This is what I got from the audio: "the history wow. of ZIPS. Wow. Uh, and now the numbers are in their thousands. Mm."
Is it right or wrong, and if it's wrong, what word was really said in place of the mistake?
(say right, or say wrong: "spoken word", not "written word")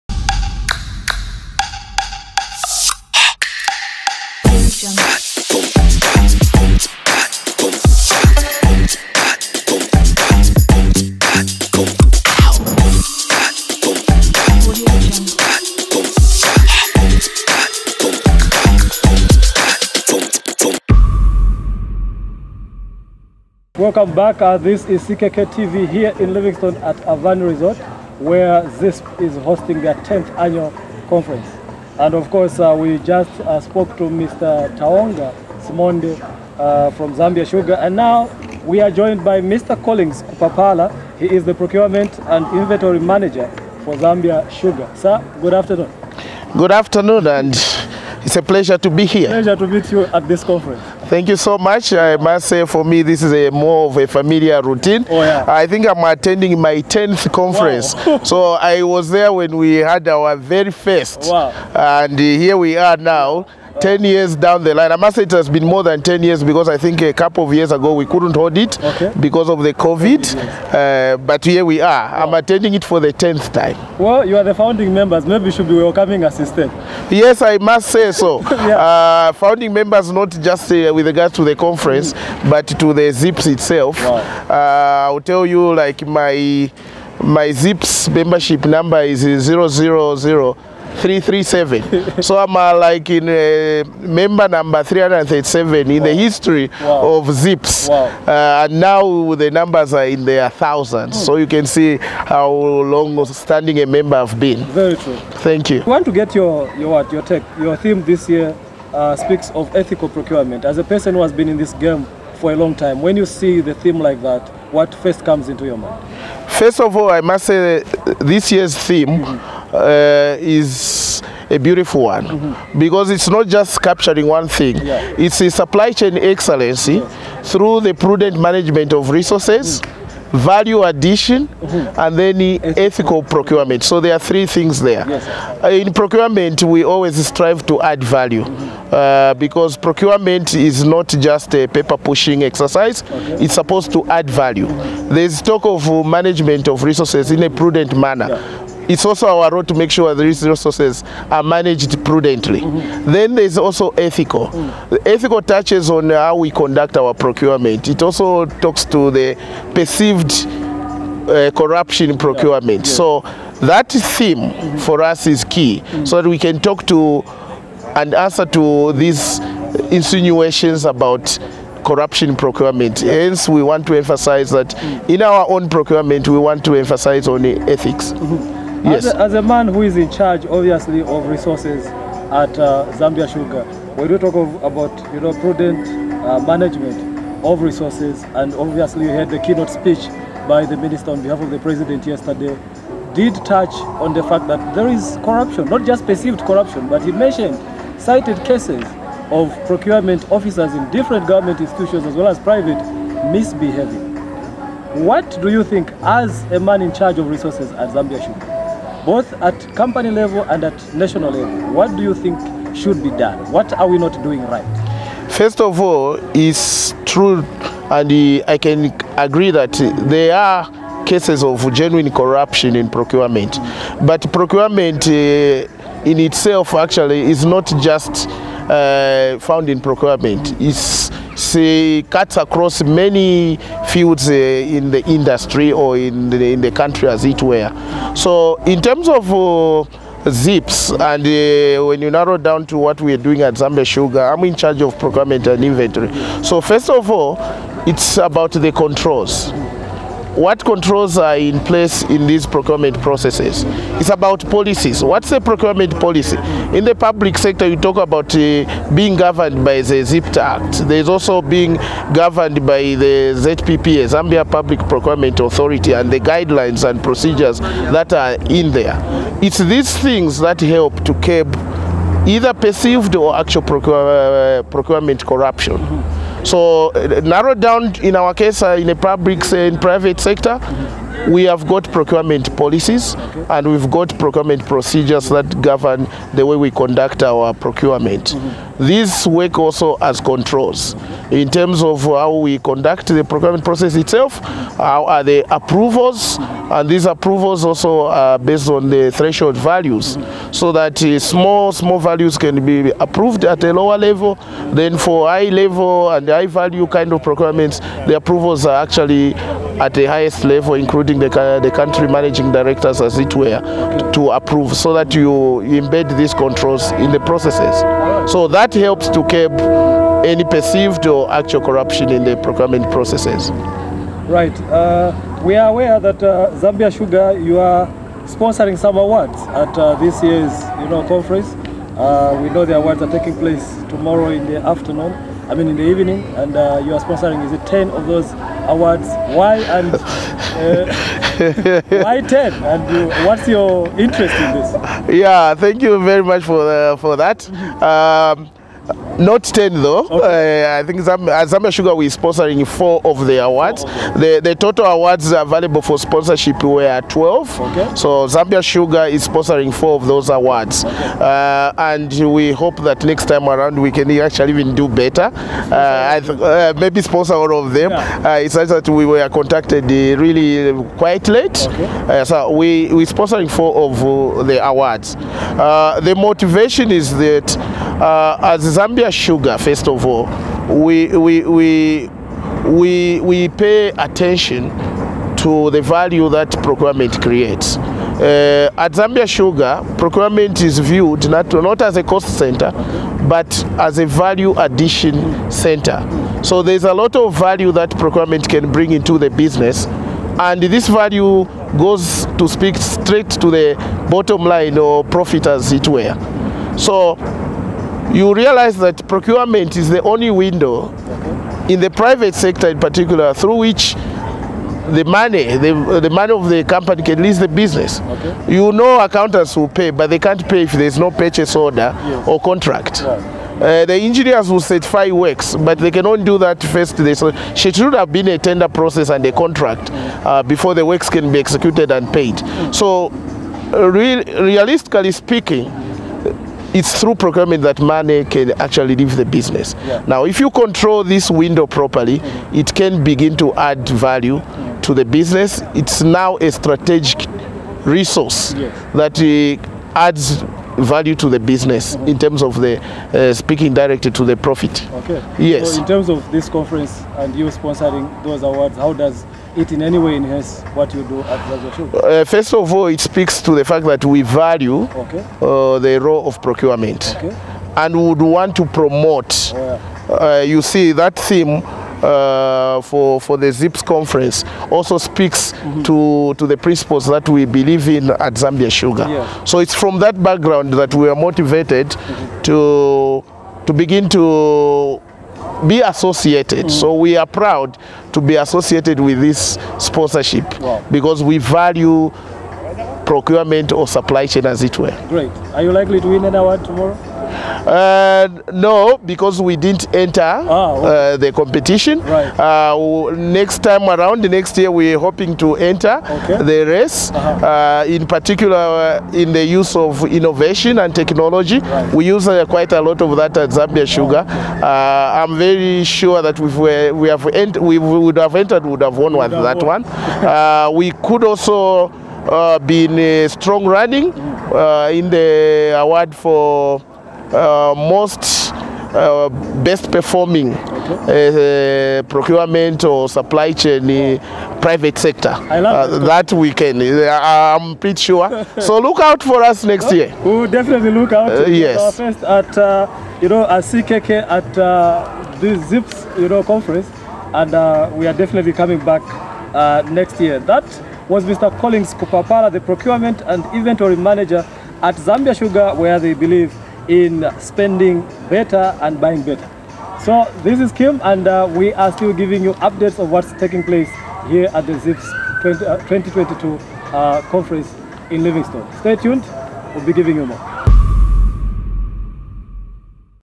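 right.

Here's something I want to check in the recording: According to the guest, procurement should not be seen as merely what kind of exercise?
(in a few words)
paper pushing exercise.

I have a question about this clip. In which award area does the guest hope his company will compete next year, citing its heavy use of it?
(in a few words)
innovation and technology.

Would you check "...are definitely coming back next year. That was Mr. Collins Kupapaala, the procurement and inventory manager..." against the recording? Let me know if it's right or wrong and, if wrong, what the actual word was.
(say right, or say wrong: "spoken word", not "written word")
right.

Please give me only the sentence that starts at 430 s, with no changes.
uh, before the works can be executed and paid.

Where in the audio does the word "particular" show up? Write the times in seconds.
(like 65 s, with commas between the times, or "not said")
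412 s, 508 s.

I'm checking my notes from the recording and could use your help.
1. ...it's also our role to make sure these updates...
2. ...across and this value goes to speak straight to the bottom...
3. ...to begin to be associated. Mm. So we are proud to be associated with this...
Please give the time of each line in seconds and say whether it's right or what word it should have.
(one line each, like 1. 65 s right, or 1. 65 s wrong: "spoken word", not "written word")
1. 148 s wrong: "resources", not "updates"
2. 399 s wrong: "business", not "across"
3. 483 s right.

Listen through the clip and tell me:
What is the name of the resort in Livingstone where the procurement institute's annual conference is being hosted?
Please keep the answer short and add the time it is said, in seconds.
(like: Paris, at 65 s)
Avani Resort, at 27 s.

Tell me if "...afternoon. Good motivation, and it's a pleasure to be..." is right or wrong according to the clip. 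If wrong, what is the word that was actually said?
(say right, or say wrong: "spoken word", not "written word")
wrong: "afternoon", not "motivation".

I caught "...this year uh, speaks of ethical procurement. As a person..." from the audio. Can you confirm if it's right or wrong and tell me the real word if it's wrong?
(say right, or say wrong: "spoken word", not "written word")
right.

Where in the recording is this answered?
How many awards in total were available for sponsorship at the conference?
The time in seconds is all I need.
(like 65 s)
357 s.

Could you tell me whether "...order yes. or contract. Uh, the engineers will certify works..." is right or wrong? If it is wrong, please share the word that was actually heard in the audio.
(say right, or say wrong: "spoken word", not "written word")
right.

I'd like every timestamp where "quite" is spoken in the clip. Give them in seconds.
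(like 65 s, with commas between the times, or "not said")
370 s, 512 s.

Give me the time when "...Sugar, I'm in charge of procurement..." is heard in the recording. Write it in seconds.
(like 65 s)
243 s.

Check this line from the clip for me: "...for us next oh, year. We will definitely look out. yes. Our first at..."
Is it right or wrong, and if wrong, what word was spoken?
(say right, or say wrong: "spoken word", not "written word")
right.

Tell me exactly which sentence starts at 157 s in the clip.
It also talks to the perceived uh, corruption procurement.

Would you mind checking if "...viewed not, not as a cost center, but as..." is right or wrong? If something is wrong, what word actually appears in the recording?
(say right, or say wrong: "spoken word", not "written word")
right.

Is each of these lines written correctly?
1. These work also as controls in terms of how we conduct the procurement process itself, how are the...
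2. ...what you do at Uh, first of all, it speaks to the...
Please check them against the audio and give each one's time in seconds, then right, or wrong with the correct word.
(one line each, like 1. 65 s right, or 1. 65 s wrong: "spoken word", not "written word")
1. 288 s right
2. 460 s right.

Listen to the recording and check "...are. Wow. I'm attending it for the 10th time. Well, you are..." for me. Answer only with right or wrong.
right.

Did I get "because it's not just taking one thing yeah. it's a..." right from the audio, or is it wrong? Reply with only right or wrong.
wrong.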